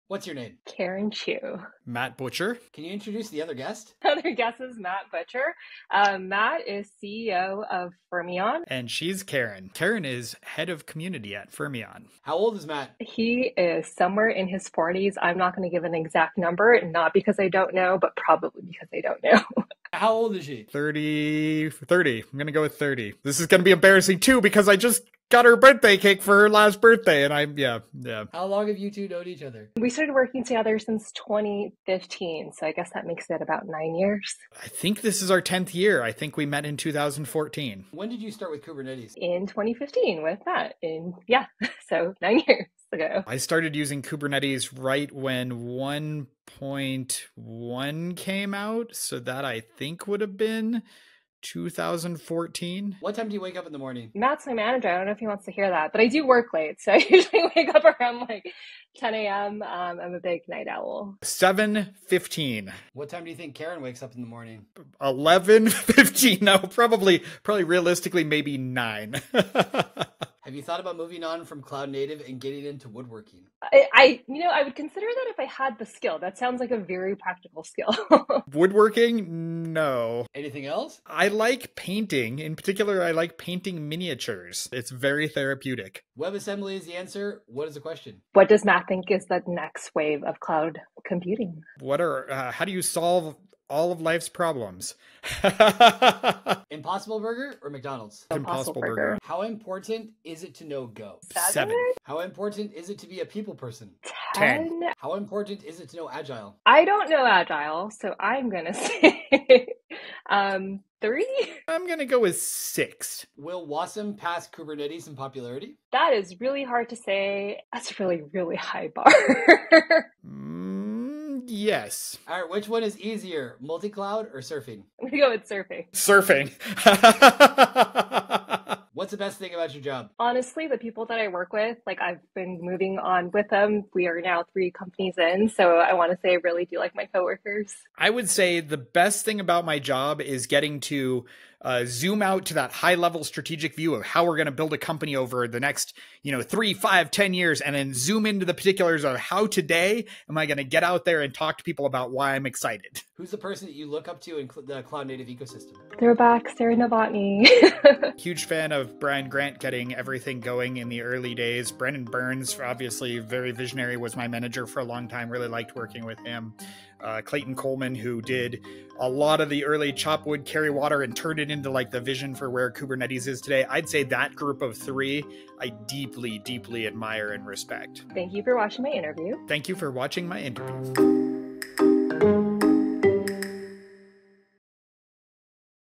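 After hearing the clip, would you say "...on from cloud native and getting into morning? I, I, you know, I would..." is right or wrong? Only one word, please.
wrong.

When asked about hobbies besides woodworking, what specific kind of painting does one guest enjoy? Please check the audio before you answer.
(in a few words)
Miniatures.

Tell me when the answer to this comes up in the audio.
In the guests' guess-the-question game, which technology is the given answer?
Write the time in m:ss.
1:26.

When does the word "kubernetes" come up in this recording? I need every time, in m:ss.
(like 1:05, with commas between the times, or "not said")
0:38, 0:44, 1:54, 2:52.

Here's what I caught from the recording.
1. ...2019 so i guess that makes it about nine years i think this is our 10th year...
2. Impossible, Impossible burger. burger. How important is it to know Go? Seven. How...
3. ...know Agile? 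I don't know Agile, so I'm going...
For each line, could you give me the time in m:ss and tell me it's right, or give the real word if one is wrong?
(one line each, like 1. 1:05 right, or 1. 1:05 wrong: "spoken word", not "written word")
1. 0:31 wrong: "2015", not "2019"
2. 1:38 right
3. 1:45 right.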